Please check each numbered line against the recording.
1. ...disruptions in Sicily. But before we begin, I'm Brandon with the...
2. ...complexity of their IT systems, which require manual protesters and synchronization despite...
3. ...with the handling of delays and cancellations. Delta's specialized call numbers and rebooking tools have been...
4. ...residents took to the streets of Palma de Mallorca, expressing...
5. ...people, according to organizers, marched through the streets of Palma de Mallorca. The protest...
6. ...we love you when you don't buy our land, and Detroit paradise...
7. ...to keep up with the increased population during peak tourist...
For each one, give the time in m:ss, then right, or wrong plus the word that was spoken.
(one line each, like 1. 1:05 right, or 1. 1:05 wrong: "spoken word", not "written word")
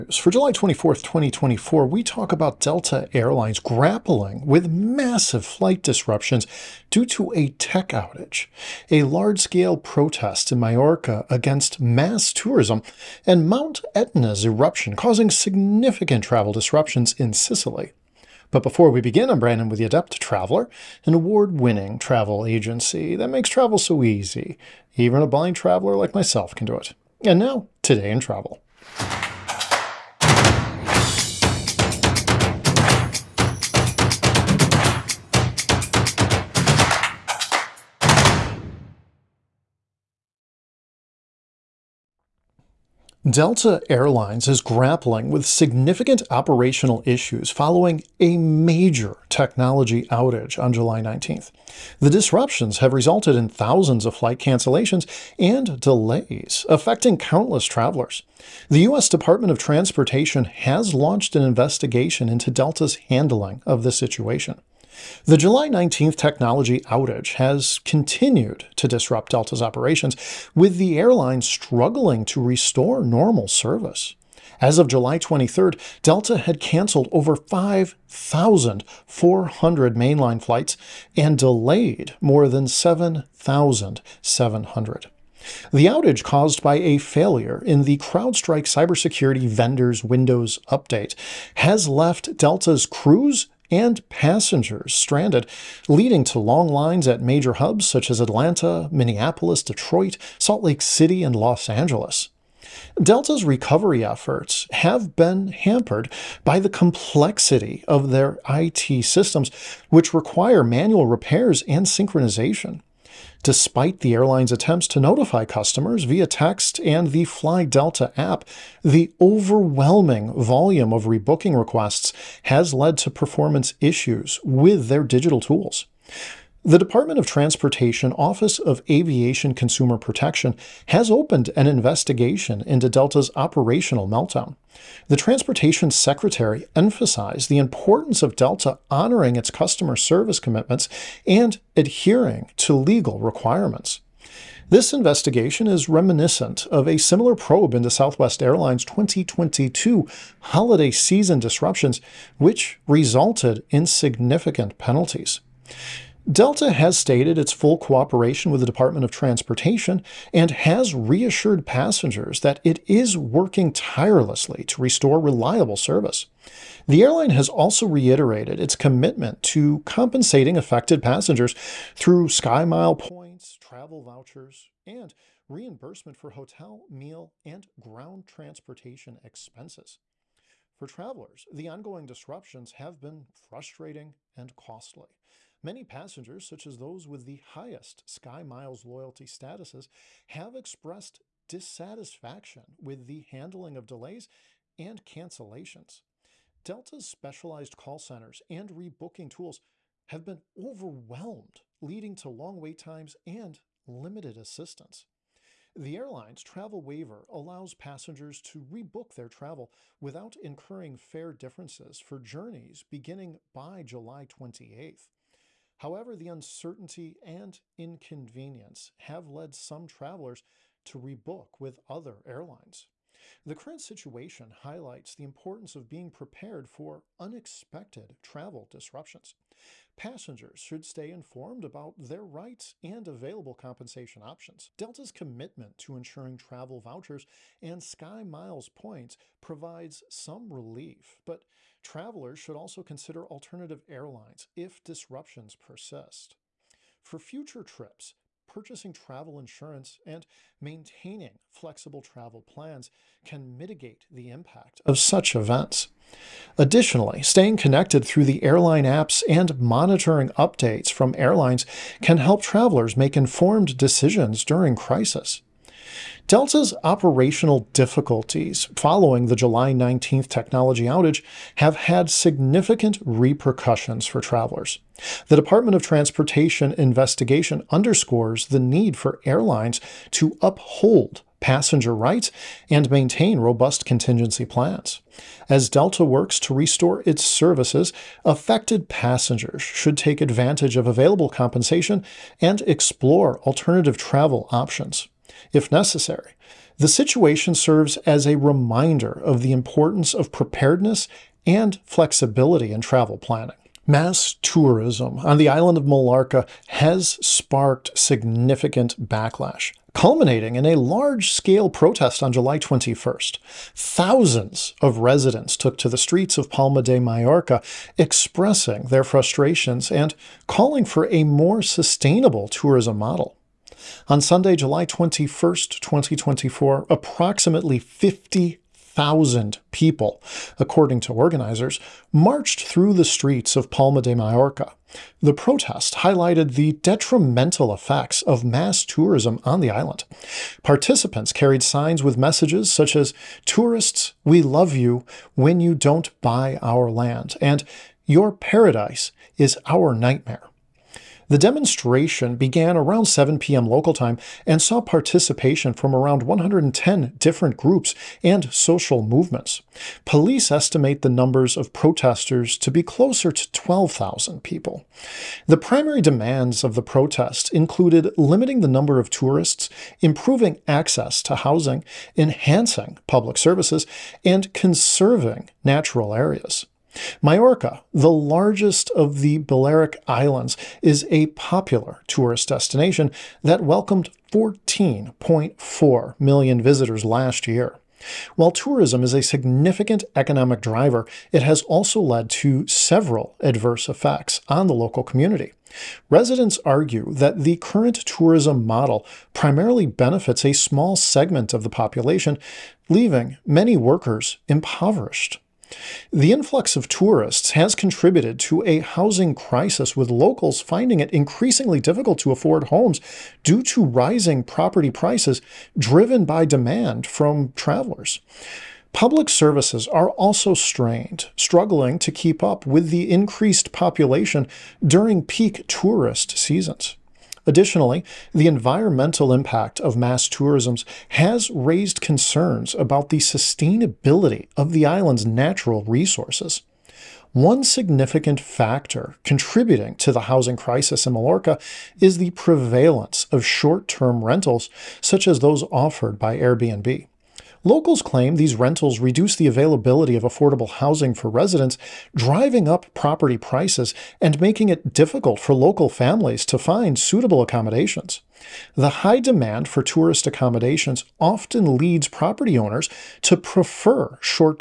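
1. 0:16 right
2. 1:46 wrong: "repairs", not "protesters"
3. 3:12 wrong: "centers", not "numbers"
4. 5:14 right
5. 5:29 right
6. 5:44 wrong: "Your", not "Detroit"
7. 7:01 right.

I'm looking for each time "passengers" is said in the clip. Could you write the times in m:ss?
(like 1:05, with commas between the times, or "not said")
1:34, 2:41, 2:51, 3:05, 3:27, 3:49, 4:41, 4:48.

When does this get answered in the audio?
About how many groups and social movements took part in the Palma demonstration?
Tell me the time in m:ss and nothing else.
5:56.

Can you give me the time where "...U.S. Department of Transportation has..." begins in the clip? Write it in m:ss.
0:58.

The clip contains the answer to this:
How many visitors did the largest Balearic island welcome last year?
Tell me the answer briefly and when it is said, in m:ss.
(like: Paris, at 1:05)
14.4 million, at 6:24.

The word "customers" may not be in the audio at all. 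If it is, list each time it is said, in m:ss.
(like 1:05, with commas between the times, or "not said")
1:55, 2:19.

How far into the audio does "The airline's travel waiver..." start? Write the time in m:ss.
3:25.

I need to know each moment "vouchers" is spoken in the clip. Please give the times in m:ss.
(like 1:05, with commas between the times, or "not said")
2:54, 3:56.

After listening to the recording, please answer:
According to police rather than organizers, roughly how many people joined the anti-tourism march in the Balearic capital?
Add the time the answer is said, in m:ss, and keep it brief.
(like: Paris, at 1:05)
12,000, at 6:03.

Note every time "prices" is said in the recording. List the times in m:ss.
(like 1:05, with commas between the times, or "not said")
6:54, 7:33.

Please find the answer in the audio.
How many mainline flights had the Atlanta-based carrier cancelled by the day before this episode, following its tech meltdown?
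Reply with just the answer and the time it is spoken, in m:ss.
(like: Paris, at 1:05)
over 5,400, at 1:17.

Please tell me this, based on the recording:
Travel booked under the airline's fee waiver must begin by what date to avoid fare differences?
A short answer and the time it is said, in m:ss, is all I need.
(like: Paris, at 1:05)
July 28th, at 3:33.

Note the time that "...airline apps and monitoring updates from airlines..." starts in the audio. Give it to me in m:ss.
4:18.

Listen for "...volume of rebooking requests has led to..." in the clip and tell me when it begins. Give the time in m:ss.
2:00.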